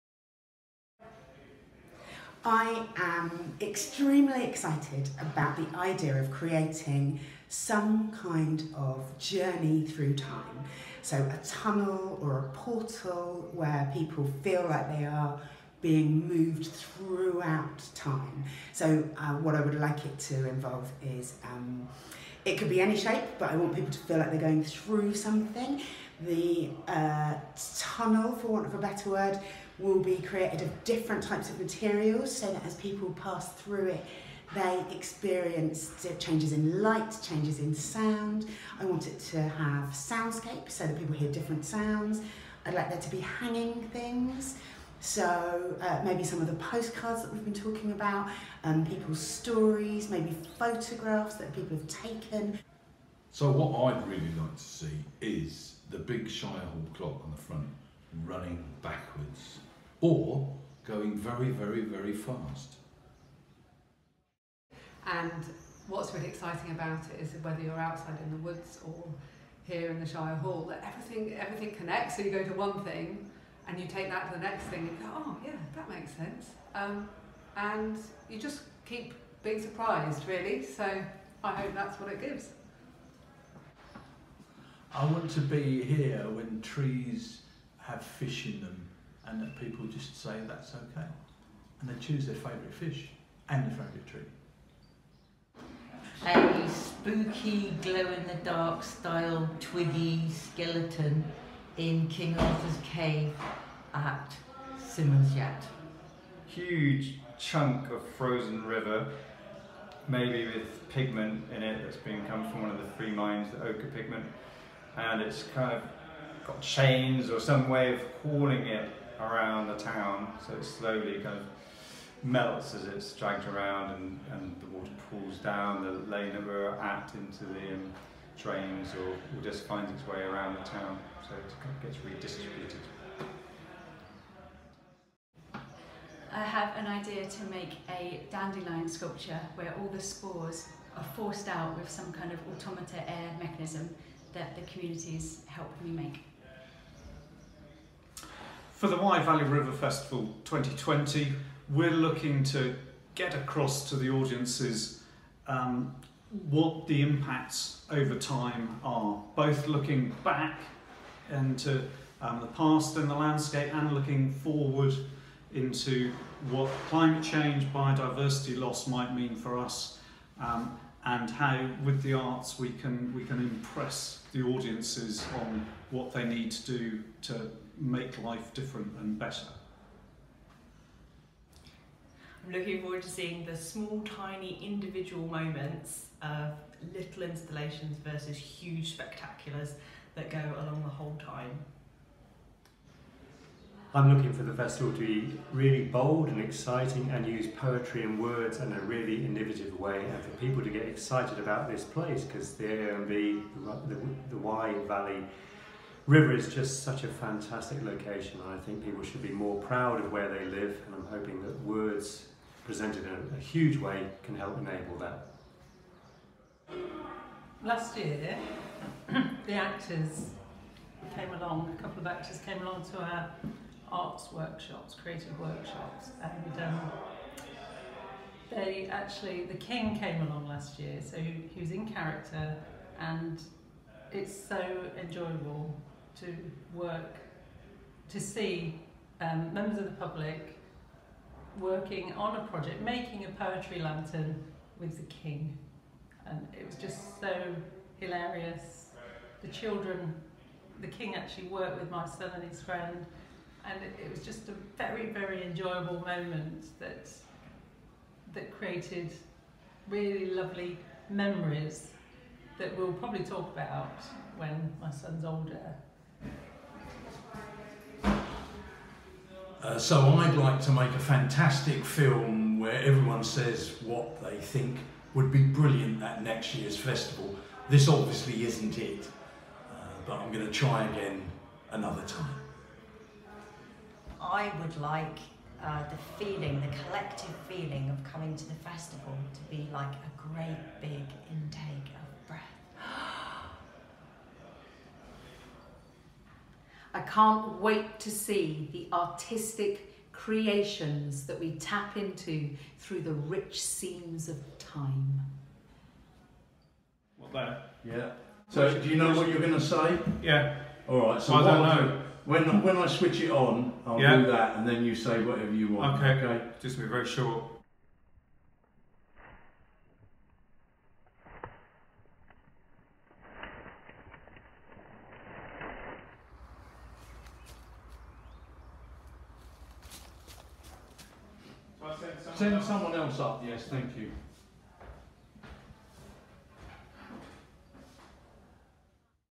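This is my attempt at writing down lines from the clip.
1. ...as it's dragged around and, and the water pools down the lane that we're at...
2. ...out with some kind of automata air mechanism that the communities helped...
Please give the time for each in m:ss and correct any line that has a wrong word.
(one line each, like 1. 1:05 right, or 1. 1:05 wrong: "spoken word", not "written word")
1. 2:02 right
2. 2:21 right.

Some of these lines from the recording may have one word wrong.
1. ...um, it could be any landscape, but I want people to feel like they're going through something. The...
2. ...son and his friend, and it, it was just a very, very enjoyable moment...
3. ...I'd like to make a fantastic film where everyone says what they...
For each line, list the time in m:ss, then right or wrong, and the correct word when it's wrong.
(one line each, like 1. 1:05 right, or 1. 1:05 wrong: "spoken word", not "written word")
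1. 0:21 wrong: "shape", not "landscape"
2. 4:12 right
3. 4:30 right.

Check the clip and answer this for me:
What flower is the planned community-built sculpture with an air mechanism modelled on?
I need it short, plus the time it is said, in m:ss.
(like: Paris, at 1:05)
Dandelion, at 2:18.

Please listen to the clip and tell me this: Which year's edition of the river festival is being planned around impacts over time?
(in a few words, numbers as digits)
2020.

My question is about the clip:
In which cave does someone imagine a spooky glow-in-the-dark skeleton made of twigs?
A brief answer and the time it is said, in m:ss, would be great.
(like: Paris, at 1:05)
King Arthur's Cave, at 1:42.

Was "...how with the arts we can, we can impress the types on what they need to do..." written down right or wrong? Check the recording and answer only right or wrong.
wrong.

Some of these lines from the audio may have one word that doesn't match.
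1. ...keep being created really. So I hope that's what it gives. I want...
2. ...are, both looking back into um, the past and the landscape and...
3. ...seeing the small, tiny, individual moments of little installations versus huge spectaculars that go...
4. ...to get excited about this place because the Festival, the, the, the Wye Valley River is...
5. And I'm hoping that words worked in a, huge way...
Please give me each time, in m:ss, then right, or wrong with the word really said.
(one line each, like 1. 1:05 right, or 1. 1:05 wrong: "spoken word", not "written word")
1. 1:18 wrong: "surprised", not "created"
2. 2:38 right
3. 3:03 right
4. 3:20 wrong: "AMV", not "Festival"
5. 3:30 wrong: "presented", not "worked".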